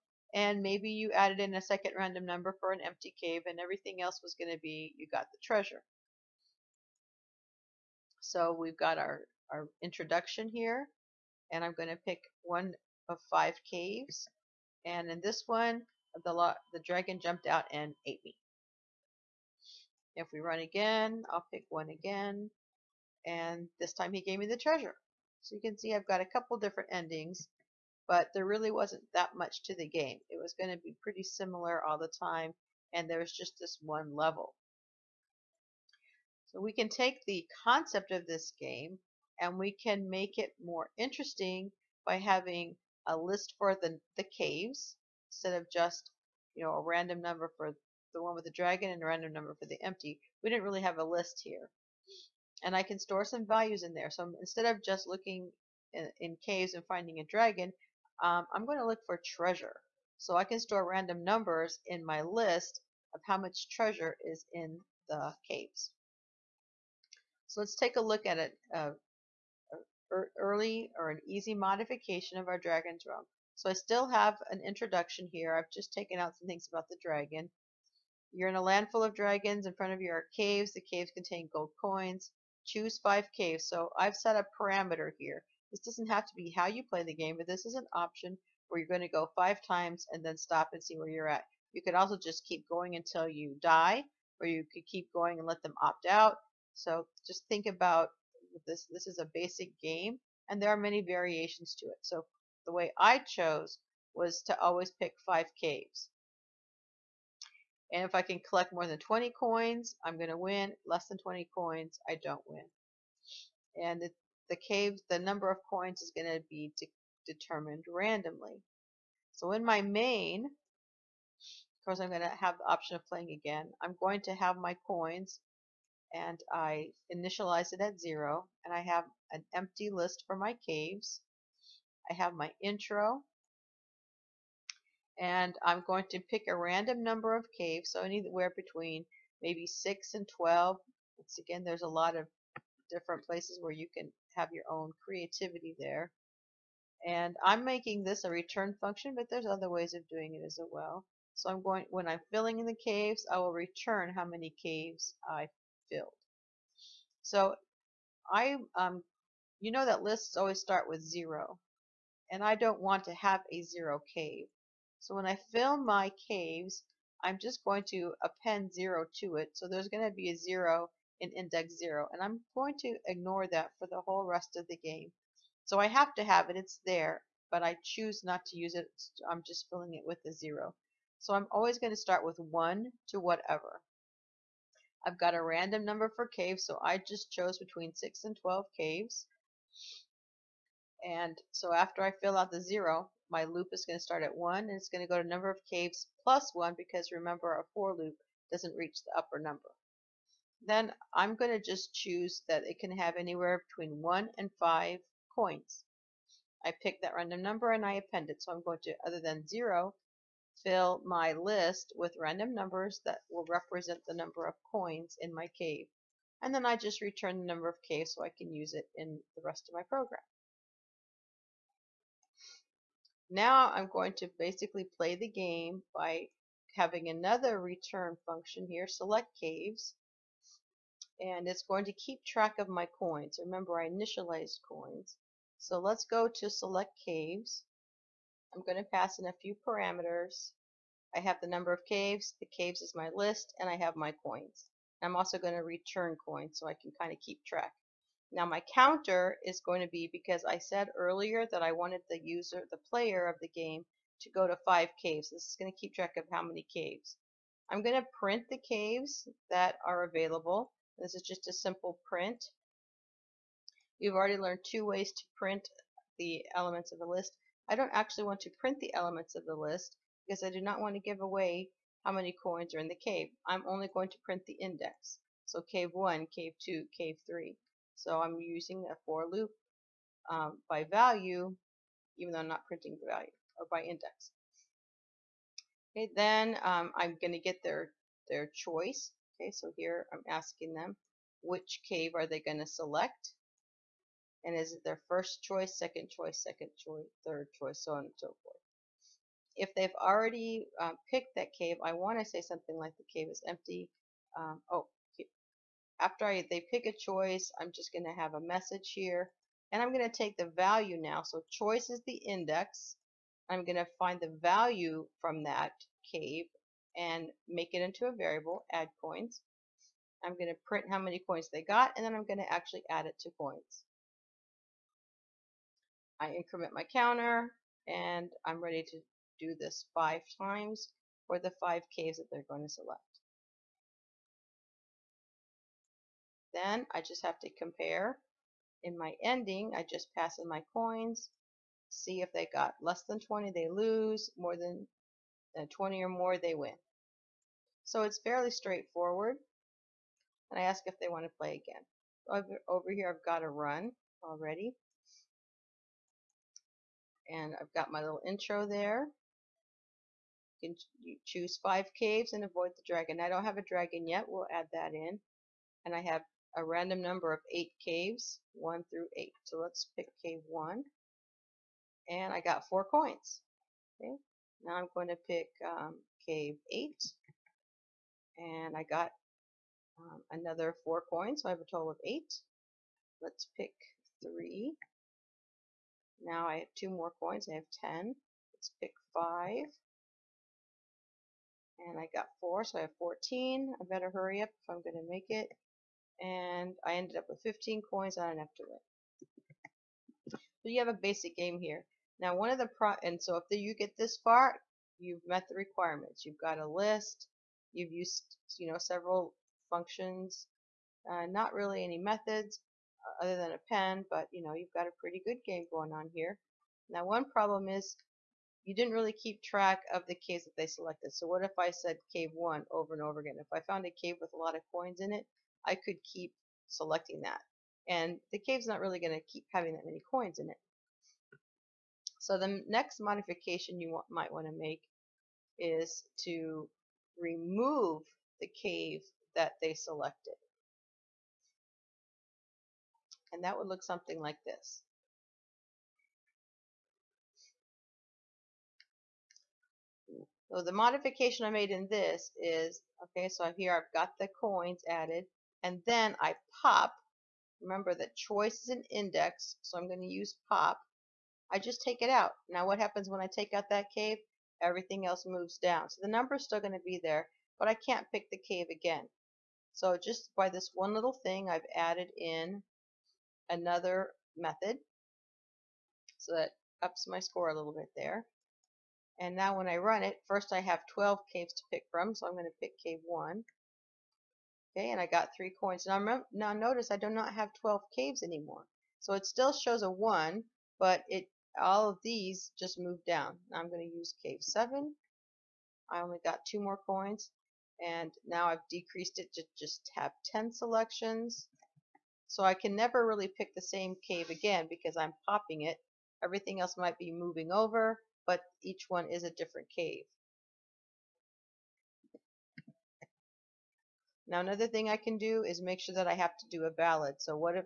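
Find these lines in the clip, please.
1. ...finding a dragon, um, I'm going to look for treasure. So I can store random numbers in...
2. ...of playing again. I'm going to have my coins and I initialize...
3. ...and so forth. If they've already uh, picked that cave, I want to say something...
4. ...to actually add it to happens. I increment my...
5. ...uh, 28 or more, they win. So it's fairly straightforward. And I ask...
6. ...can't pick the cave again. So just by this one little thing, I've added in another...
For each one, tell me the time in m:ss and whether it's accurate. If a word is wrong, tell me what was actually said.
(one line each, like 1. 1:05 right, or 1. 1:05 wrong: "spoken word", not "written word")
1. 0:56 right
2. 2:02 right
3. 4:58 right
4. 5:22 wrong: "coins", not "happens"
5. 5:45 wrong: "20", not "28"
6. 7:47 right.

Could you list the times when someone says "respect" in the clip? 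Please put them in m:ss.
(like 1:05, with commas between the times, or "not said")
not said.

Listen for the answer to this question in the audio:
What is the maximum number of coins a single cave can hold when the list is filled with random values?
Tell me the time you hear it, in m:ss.
3:23.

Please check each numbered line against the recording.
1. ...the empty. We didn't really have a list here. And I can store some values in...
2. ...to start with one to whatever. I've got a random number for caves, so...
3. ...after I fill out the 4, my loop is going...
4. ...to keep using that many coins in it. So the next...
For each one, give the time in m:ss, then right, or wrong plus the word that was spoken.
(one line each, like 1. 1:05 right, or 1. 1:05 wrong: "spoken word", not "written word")
1. 0:49 right
2. 3:01 right
3. 3:11 wrong: "0", not "4"
4. 7:09 wrong: "having", not "using".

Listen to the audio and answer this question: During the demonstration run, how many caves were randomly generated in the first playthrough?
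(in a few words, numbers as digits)
8.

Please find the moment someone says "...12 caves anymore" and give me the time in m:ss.
8:07.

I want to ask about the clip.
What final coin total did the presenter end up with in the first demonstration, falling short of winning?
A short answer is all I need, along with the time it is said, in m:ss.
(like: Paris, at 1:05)
15, at 6:37.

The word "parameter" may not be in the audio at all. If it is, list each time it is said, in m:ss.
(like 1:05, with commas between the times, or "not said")
1:24, 3:59.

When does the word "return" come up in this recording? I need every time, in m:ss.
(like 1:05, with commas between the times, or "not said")
2:28, 2:33, 3:37, 3:47, 4:05.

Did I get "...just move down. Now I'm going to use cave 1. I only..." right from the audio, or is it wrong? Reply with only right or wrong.
wrong.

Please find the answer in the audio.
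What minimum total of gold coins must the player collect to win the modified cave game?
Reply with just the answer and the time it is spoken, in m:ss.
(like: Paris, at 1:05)
20, at 1:48.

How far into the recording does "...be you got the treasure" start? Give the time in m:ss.
0:04.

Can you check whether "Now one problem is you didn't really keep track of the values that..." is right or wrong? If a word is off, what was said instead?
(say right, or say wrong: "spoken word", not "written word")
wrong: "caves", not "values".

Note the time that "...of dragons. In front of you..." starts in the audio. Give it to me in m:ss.
1:19.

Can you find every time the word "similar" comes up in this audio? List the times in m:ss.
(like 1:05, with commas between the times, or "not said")
0:31.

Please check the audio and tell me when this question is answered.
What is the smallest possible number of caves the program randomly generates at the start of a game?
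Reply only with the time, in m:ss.
2:18.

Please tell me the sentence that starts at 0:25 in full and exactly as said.
So you can see I've got a couple different endings, but there really wasn't that much to the game.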